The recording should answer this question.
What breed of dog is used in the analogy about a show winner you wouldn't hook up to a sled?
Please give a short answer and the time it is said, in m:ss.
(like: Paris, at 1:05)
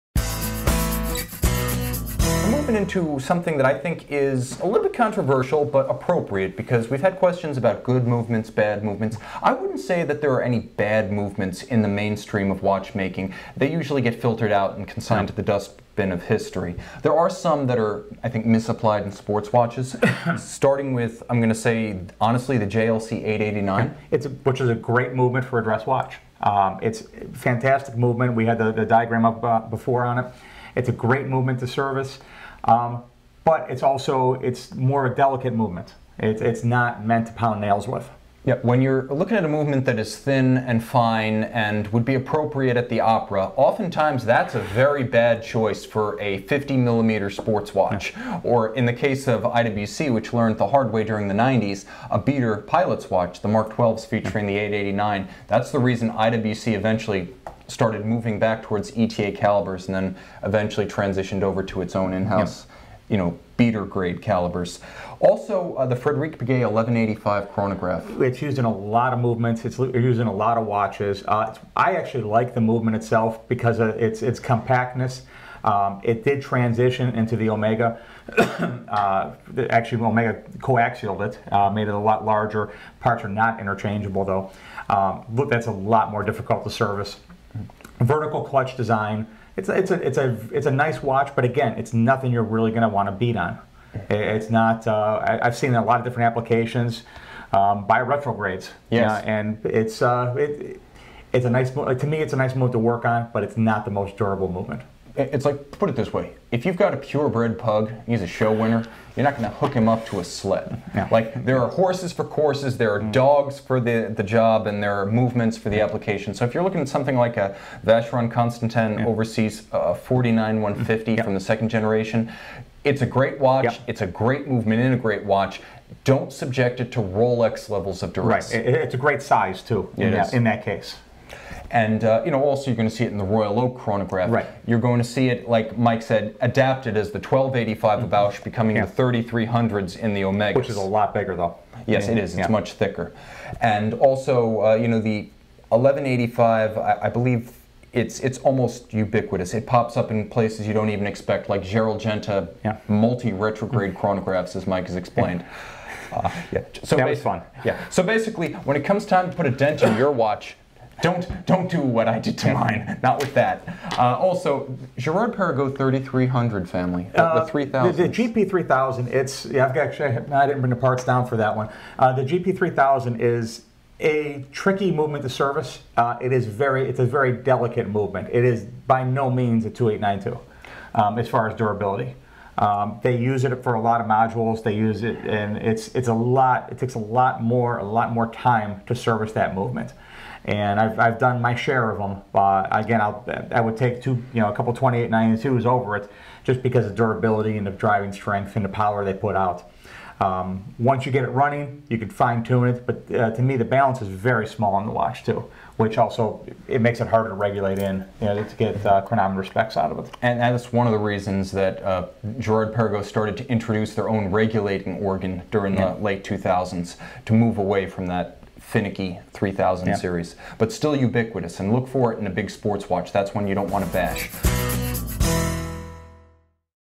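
Pug, at 1:47.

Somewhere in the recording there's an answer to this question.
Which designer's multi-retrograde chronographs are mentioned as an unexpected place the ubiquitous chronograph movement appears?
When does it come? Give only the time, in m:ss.
2:31.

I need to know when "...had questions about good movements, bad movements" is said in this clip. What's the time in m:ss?
0:07.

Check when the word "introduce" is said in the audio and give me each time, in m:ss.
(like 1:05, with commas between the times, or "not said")
3:33.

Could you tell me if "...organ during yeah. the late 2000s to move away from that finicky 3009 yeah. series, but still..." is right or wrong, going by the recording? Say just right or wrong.
wrong.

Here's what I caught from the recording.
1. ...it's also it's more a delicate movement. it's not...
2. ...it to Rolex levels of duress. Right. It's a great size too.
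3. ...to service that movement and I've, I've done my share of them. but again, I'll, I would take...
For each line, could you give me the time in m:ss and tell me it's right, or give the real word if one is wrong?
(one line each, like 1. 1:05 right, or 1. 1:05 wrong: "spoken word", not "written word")
1. 0:33 right
2. 2:06 right
3. 3:08 right.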